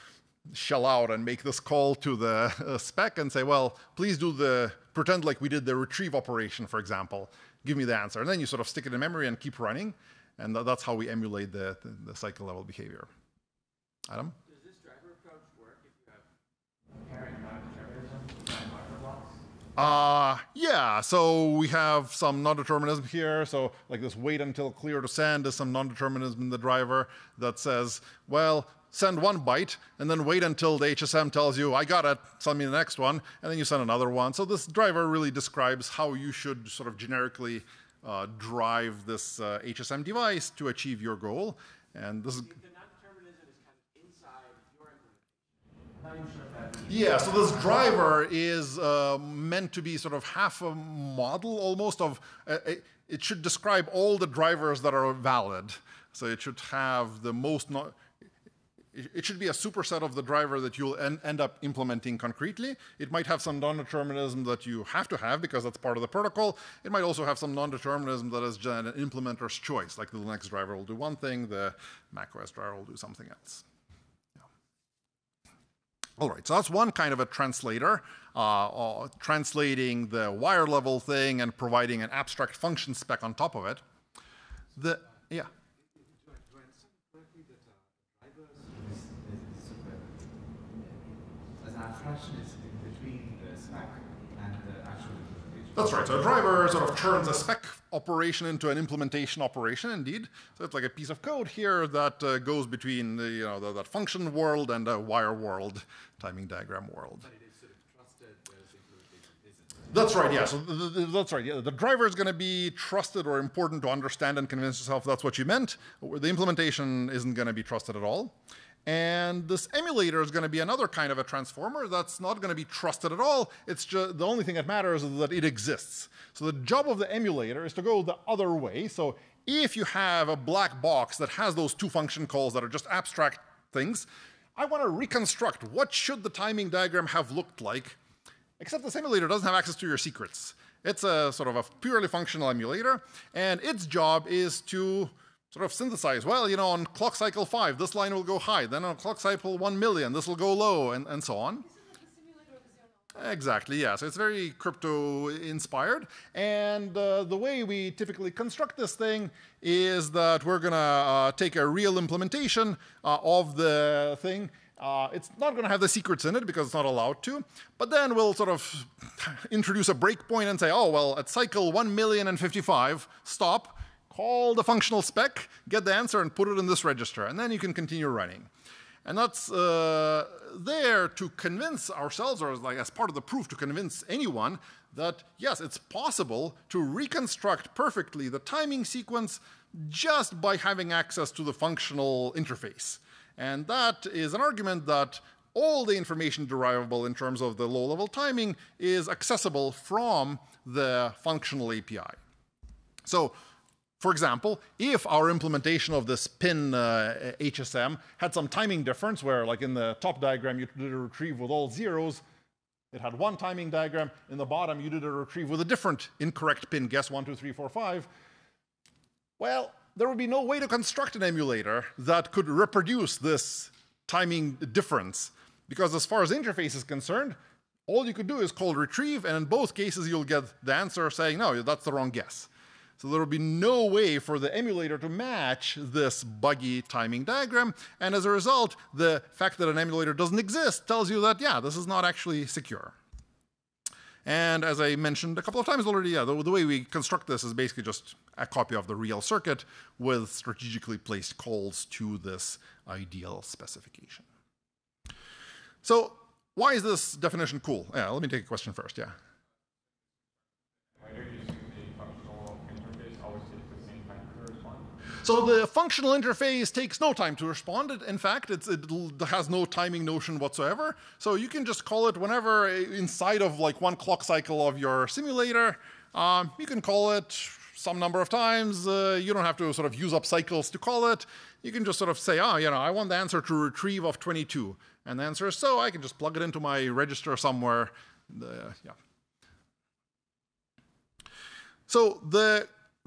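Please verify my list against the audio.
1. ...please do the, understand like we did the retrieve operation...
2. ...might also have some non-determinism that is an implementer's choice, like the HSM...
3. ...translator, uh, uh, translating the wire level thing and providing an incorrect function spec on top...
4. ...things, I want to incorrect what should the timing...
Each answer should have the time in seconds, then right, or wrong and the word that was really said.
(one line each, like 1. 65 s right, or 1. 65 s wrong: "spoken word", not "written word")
1. 3 s wrong: "pretend", not "understand"
2. 66 s wrong: "Linux", not "HSM"
3. 77 s wrong: "abstract", not "incorrect"
4. 133 s wrong: "reconstruct", not "incorrect".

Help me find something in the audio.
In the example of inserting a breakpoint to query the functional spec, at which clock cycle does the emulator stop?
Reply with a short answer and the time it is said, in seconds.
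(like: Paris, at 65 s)
1,055, at 171 s.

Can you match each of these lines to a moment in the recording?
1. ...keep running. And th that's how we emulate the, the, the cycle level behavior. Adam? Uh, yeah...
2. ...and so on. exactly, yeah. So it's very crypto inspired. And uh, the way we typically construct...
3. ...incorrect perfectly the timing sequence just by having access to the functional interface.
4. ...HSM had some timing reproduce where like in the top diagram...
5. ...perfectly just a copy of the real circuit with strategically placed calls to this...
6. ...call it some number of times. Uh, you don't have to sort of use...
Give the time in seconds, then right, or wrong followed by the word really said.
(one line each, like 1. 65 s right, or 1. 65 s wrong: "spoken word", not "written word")
1. 9 s right
2. 151 s right
3. 186 s wrong: "reconstruct", not "incorrect"
4. 207 s wrong: "difference", not "reproduce"
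5. 247 s wrong: "basically", not "perfectly"
6. 276 s right.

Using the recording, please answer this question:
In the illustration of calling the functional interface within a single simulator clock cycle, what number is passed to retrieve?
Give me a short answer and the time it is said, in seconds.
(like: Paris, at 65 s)
22, at 283 s.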